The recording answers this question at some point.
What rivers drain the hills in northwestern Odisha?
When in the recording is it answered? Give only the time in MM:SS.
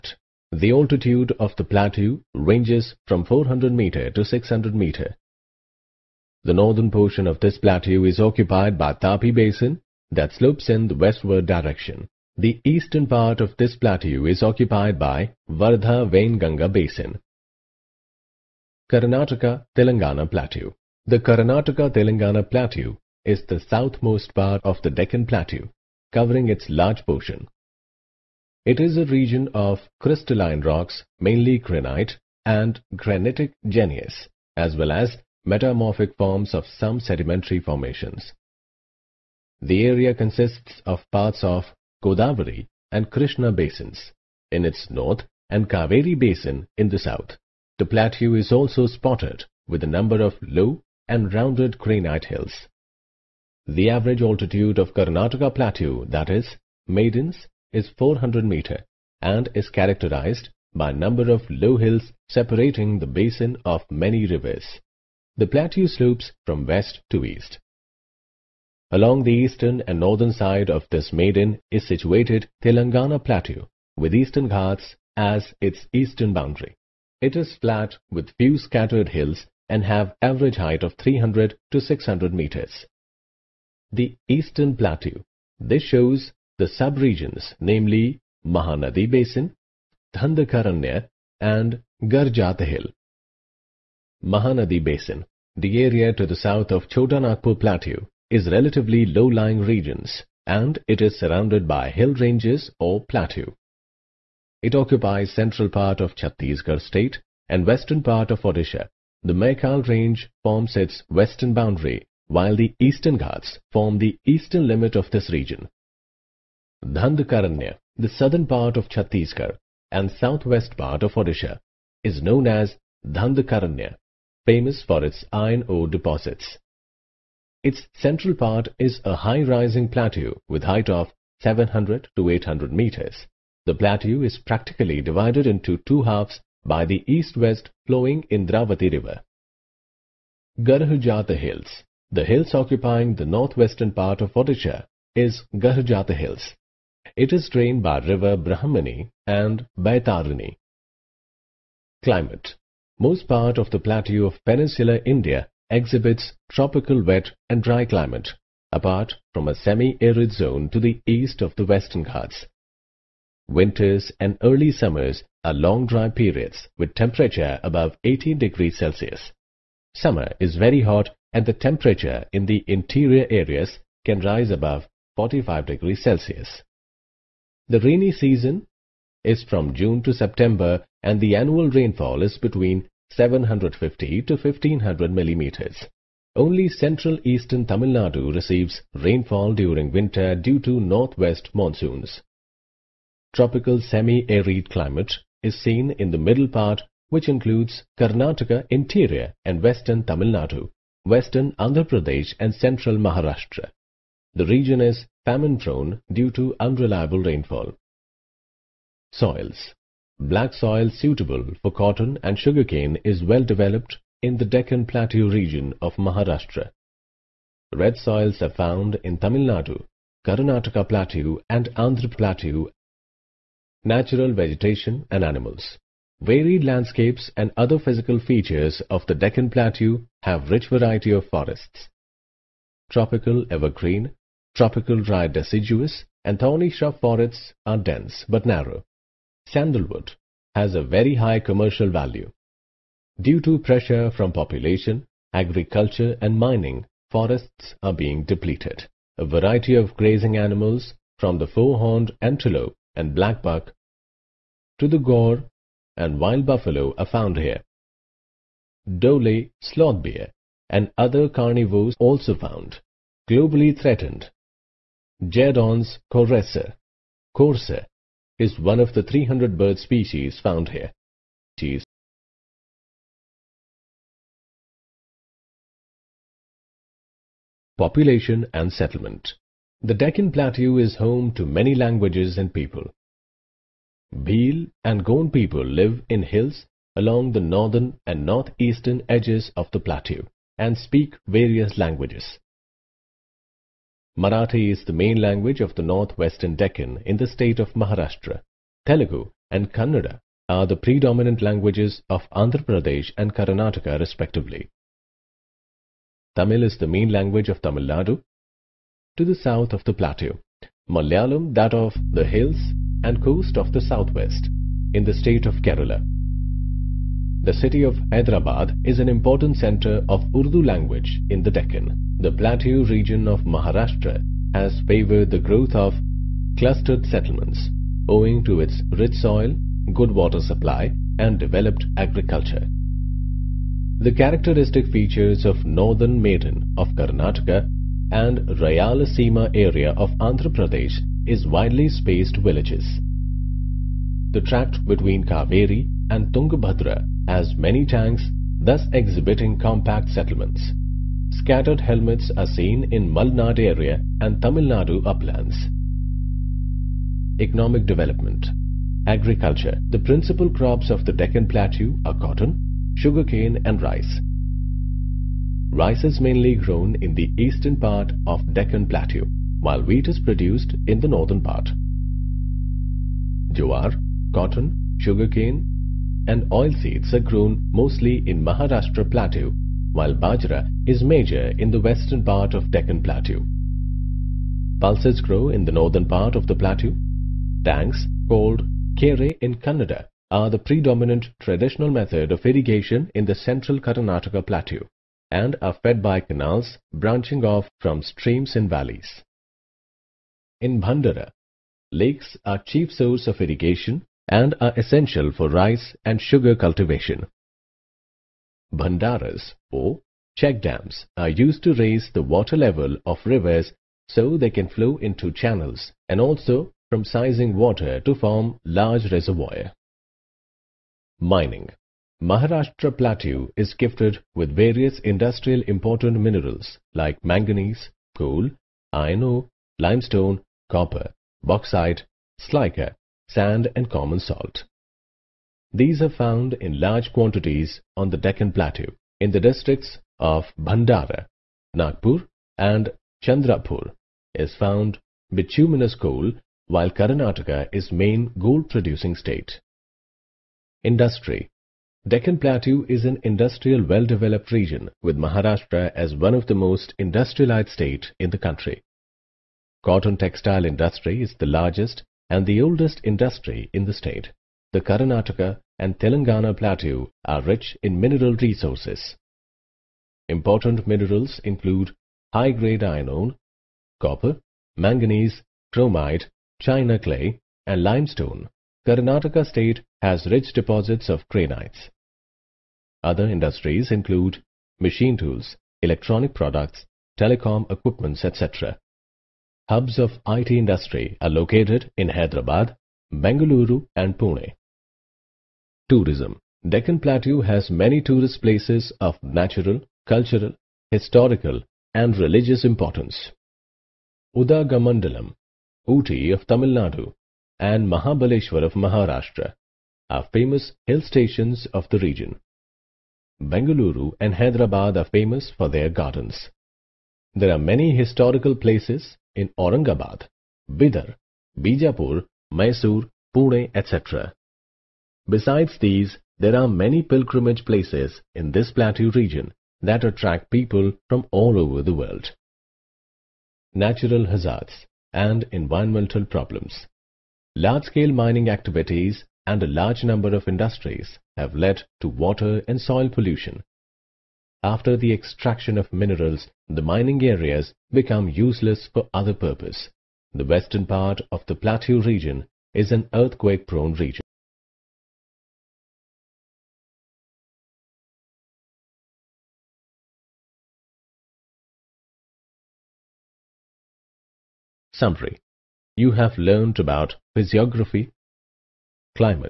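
02:28.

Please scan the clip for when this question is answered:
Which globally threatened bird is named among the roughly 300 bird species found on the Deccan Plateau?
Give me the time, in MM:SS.
04:25.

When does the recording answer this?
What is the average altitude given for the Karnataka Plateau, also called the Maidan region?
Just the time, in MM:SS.
00:57.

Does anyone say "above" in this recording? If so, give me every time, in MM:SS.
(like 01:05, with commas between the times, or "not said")
02:47, 02:54.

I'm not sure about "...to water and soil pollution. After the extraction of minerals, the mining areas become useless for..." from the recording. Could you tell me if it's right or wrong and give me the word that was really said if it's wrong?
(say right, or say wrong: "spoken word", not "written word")
right.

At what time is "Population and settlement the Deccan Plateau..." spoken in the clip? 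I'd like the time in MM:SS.
04:37.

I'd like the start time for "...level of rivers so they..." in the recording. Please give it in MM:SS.
06:52.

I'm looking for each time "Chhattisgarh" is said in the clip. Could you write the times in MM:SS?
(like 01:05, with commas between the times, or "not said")
01:46, 01:58.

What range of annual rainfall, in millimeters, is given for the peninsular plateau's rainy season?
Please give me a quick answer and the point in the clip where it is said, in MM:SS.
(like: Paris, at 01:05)
750 to 1500 mm, at 03:03.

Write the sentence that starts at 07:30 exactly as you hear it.
Industry Deccan Plateau is an industrial well-developed region with Maharashtra as one of the most industrialized state in the country.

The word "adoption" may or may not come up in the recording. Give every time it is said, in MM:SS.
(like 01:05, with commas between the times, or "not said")
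not said.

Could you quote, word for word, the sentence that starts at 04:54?
Marathi is the main language of the northwestern Deccan in the state of Maharashtra.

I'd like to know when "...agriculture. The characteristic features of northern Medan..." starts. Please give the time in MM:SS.
05:31.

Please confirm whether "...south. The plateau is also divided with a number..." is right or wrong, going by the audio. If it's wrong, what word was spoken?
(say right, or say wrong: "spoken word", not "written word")
wrong: "spotted", not "divided".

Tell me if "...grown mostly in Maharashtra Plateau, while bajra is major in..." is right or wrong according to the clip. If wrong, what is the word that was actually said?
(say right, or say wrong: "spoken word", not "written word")
right.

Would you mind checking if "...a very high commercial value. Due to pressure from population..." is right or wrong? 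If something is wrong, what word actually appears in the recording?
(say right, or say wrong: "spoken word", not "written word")
right.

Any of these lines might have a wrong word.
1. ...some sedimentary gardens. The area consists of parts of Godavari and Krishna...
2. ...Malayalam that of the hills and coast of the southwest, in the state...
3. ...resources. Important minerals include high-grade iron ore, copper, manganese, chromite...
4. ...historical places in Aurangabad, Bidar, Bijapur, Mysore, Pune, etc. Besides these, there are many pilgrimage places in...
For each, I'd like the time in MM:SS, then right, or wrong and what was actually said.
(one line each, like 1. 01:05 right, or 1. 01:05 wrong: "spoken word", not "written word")
1. 00:36 wrong: "formations", not "gardens"
2. 05:10 right
3. 07:48 right
4. 08:37 right.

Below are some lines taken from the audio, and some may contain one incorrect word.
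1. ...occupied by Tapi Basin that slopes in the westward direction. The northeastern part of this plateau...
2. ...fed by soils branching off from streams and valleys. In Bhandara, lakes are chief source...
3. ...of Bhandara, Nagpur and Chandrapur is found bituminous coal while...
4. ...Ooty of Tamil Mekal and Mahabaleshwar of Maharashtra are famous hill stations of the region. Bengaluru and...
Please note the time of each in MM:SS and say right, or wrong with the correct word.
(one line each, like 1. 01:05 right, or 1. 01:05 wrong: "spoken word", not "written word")
1. 00:08 wrong: "eastern", not "northeastern"
2. 06:35 wrong: "canals", not "soils"
3. 07:20 right
4. 08:25 wrong: "Nadu", not "Mekal".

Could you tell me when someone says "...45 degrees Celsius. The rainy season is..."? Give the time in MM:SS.
02:55.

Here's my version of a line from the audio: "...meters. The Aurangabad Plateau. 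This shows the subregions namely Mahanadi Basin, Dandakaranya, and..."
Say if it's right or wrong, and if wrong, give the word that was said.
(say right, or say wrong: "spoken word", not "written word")
wrong: "Eastern", not "Aurangabad".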